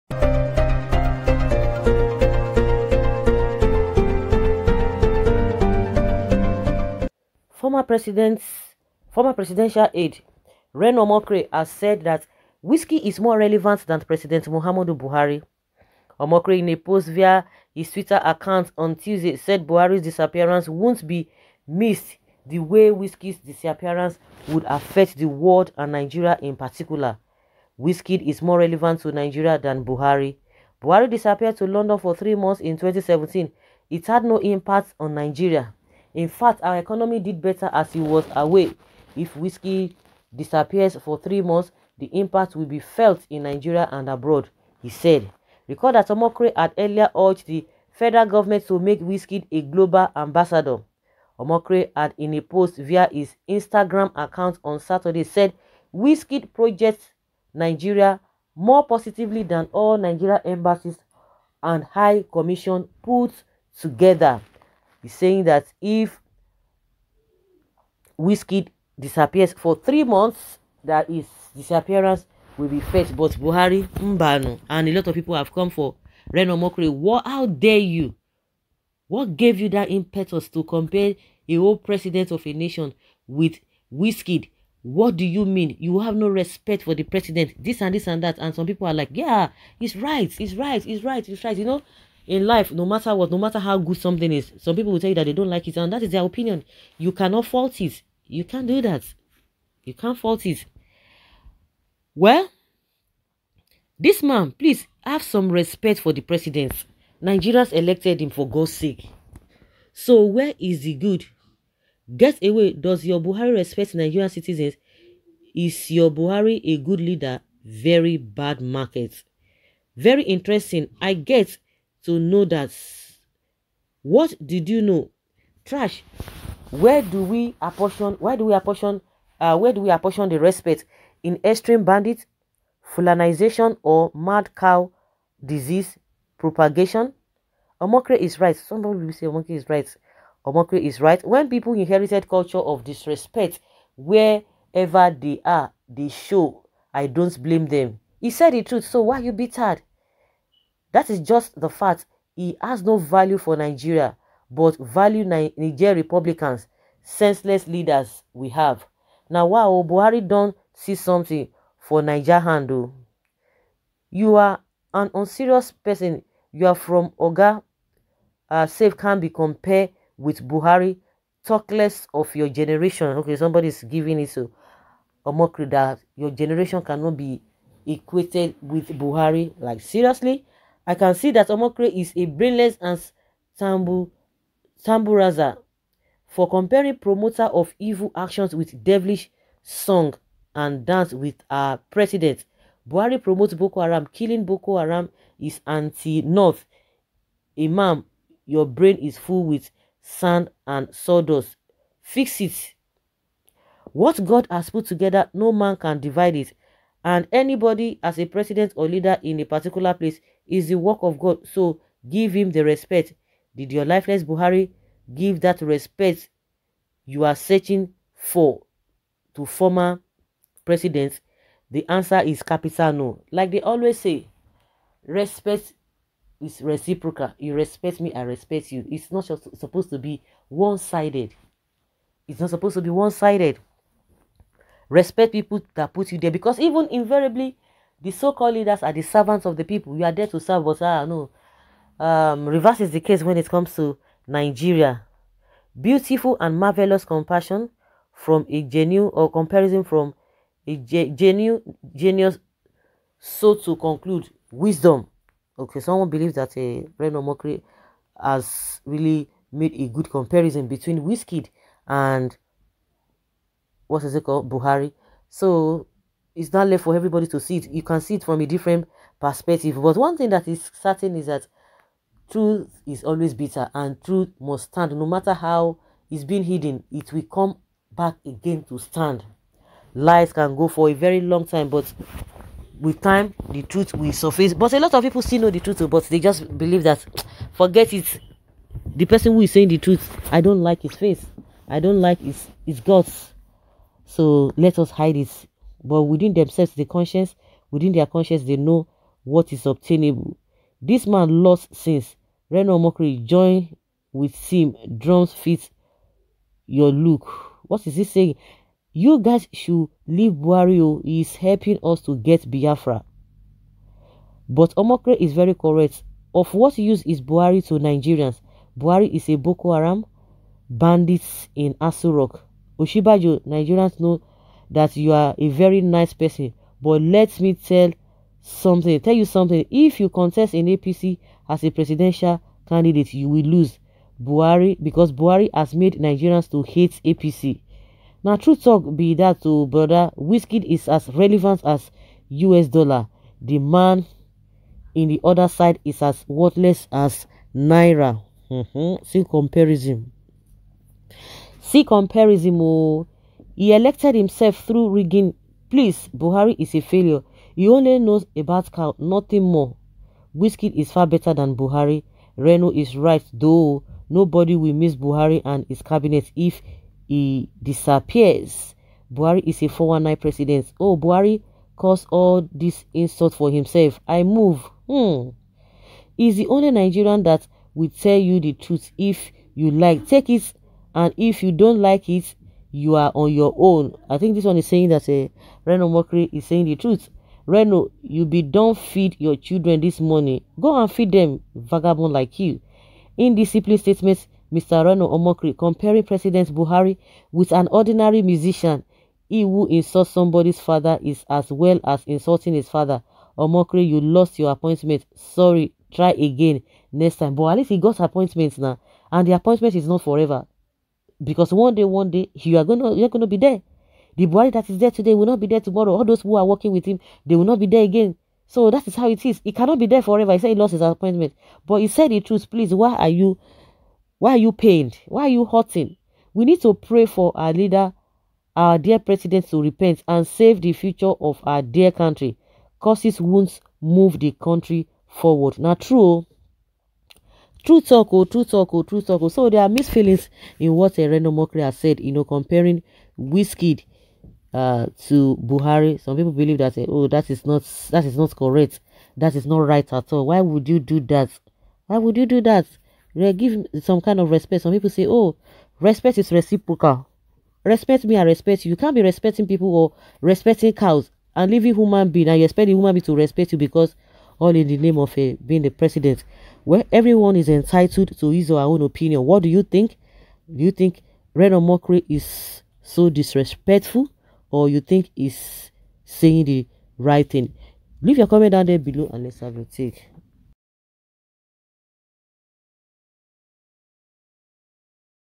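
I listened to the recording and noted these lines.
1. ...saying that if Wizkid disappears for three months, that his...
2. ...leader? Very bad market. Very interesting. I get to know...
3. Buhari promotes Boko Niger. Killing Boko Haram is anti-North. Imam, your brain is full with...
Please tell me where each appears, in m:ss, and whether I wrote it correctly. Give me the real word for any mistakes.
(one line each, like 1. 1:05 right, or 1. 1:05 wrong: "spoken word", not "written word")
1. 1:05 right
2. 1:57 right
3. 3:12 wrong: "Haram", not "Niger".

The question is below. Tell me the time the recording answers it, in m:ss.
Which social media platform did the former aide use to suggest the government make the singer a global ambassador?
0:53.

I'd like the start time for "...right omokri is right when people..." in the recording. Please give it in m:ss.
2:19.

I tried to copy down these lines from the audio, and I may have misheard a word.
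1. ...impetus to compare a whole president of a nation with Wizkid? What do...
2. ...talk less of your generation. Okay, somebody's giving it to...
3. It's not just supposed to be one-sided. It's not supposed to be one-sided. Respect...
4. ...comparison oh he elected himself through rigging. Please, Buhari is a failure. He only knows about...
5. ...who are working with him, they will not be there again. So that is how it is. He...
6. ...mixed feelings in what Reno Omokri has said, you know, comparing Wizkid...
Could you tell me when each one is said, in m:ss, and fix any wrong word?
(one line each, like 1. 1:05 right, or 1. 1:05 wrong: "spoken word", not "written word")
1. 1:19 right
2. 2:51 right
3. 3:48 right
4. 5:51 right
5. 6:56 right
6. 7:19 right.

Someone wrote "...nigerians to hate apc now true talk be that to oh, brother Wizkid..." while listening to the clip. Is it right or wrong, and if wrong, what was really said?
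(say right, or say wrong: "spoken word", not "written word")
right.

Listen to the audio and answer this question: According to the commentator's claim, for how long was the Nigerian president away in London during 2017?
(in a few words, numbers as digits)
3 months.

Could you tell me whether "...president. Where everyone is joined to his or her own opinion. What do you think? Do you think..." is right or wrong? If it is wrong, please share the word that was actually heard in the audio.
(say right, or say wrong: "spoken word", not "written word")
wrong: "entitled", not "joined".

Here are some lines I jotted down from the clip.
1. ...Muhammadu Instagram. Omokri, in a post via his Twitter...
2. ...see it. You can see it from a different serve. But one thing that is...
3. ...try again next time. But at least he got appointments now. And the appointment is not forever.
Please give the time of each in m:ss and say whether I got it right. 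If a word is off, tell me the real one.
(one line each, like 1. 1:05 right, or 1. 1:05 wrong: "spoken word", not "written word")
1. 0:14 wrong: "Buhari", not "Instagram"
2. 4:27 wrong: "perspective", not "serve"
3. 6:45 right.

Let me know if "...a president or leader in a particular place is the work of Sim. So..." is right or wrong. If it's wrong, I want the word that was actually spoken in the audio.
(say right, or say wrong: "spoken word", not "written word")
wrong: "God", not "Sim".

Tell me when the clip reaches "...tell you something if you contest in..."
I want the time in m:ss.
5:29.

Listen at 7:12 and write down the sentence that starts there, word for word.
Cause his wounds move the country forward.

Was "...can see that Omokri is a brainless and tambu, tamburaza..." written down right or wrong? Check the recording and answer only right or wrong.
right.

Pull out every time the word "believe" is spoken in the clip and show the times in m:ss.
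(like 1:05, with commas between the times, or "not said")
4:16, 4:46, 7:26.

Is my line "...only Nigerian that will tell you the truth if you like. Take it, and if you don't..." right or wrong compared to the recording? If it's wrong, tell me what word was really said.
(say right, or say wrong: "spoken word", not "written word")
right.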